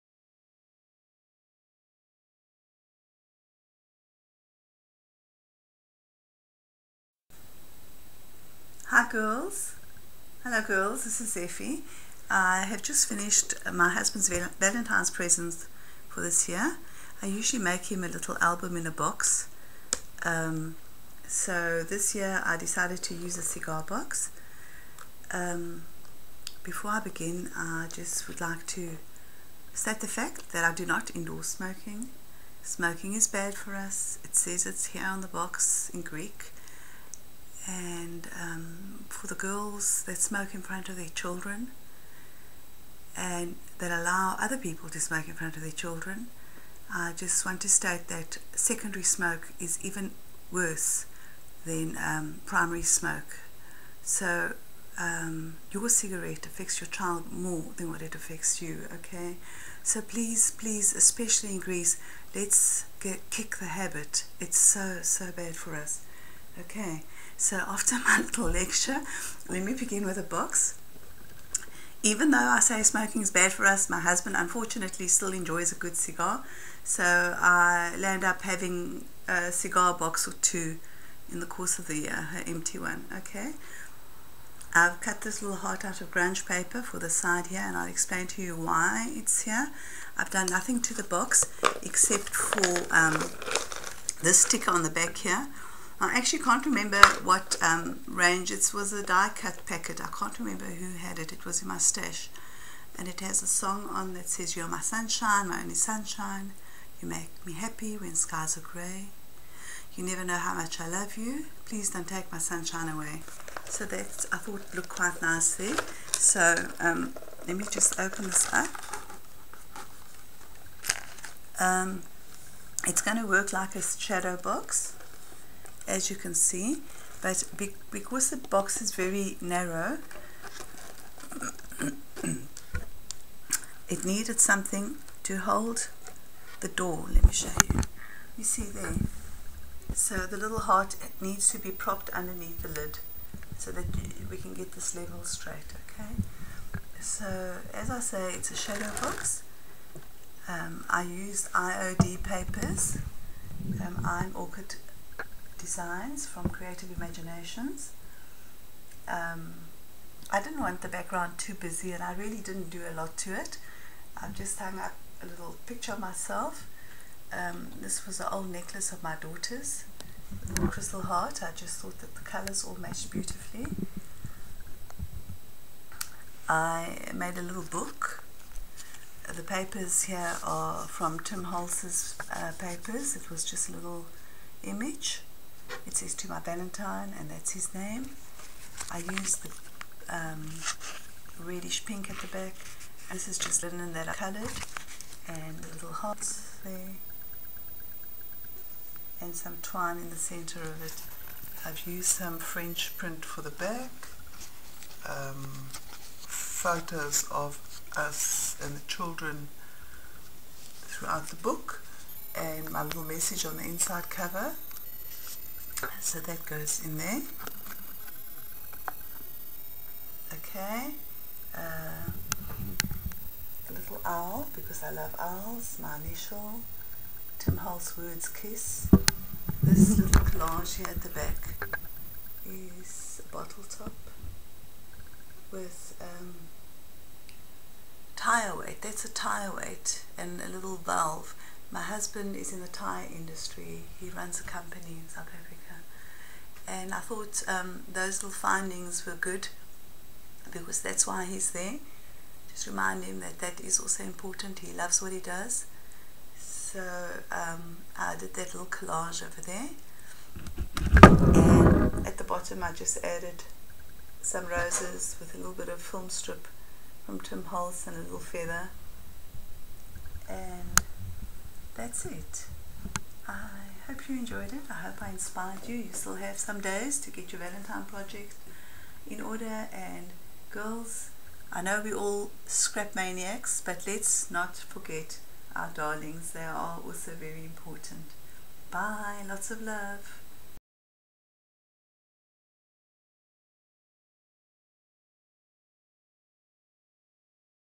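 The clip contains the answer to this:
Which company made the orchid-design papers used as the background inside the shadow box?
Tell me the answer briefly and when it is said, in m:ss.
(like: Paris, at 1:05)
Creative Imaginations, at 2:36.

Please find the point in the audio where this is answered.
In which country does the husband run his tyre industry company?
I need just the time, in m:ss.
4:05.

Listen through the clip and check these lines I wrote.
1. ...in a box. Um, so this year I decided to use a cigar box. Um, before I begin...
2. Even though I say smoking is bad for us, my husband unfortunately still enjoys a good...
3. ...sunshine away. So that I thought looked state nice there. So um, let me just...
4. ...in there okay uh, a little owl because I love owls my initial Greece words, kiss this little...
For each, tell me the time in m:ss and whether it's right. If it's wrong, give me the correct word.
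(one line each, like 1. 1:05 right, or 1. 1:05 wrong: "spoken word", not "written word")
1. 0:18 right
2. 1:12 right
3. 1:52 wrong: "quite", not "state"
4. 3:36 wrong: "Tim", not "Greece".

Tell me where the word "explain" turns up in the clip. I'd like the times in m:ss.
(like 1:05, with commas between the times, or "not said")
1:27.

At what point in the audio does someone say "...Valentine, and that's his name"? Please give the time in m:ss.
3:06.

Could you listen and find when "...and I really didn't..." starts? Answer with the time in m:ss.
2:41.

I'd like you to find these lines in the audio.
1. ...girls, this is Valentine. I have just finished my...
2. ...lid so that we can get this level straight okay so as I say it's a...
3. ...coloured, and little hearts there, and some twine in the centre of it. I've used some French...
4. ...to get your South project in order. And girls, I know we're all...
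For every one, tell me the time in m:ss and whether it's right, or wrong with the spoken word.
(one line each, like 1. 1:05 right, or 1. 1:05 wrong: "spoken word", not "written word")
1. 0:10 wrong: "Effie", not "Valentine"
2. 2:22 right
3. 3:14 right
4. 4:36 wrong: "Valentine", not "South".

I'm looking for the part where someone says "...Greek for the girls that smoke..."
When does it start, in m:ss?
0:36.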